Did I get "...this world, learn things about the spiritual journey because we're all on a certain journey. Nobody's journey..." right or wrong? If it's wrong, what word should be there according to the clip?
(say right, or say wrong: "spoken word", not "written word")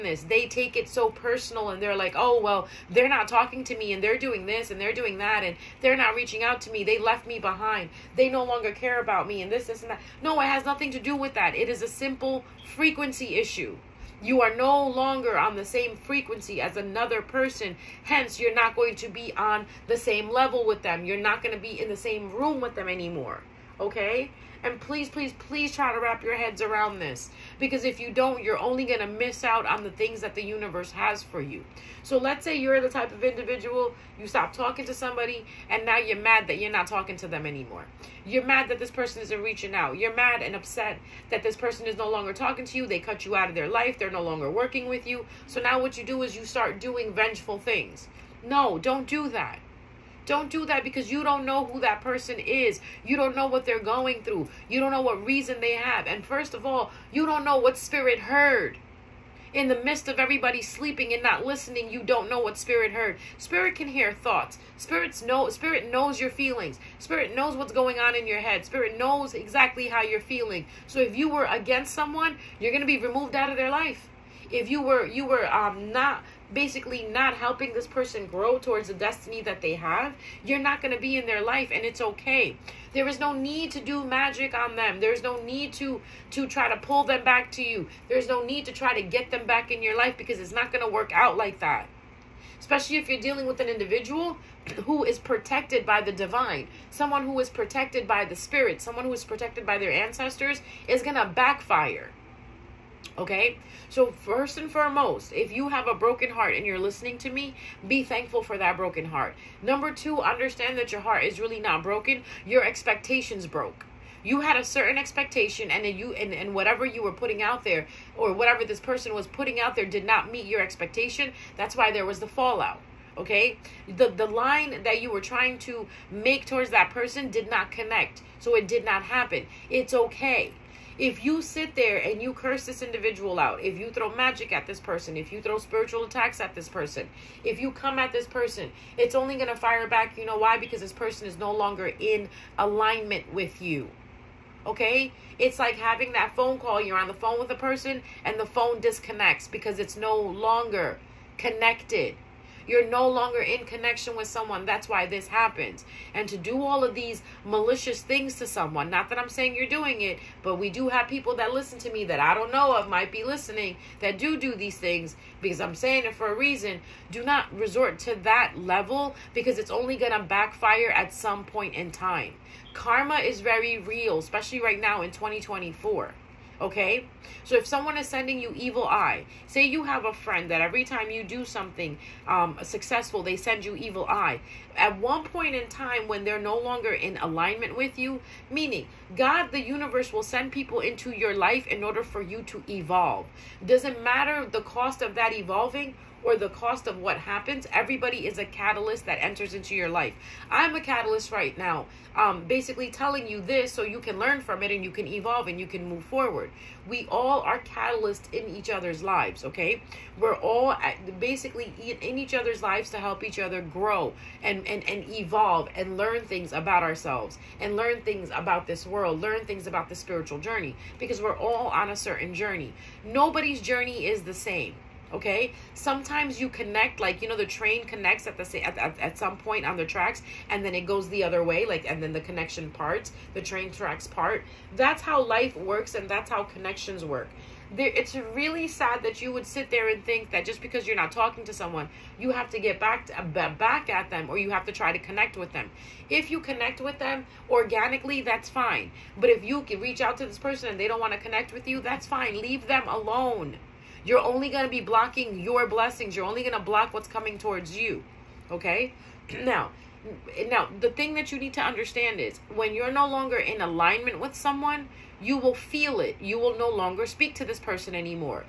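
right.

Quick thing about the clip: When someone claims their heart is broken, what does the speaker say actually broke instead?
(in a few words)
expectations.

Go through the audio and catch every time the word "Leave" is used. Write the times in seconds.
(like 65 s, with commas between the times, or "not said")
252 s.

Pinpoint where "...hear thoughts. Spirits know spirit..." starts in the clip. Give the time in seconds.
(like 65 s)
63 s.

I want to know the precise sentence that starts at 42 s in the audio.
They cut you out of their life.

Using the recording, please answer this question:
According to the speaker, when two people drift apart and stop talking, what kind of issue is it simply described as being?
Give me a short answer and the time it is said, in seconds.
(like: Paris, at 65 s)
frequency issue, at 12 s.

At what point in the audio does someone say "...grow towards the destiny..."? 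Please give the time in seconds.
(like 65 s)
78 s.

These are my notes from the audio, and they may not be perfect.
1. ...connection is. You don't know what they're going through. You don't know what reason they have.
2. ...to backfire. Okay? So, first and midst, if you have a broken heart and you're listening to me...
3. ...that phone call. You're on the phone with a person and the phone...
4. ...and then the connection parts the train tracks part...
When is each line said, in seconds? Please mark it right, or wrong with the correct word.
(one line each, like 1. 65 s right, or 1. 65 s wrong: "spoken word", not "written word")
1. 51 s wrong: "person", not "connection"
2. 101 s wrong: "foremost", not "midst"
3. 146 s right
4. 231 s right.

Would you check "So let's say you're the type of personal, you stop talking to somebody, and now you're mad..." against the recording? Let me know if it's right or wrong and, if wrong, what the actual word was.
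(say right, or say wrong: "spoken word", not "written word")
wrong: "individual", not "personal".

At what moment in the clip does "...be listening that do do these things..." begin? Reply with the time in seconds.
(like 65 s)
163 s.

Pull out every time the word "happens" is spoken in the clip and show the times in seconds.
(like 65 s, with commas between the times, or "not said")
129 s, 155 s, 197 s.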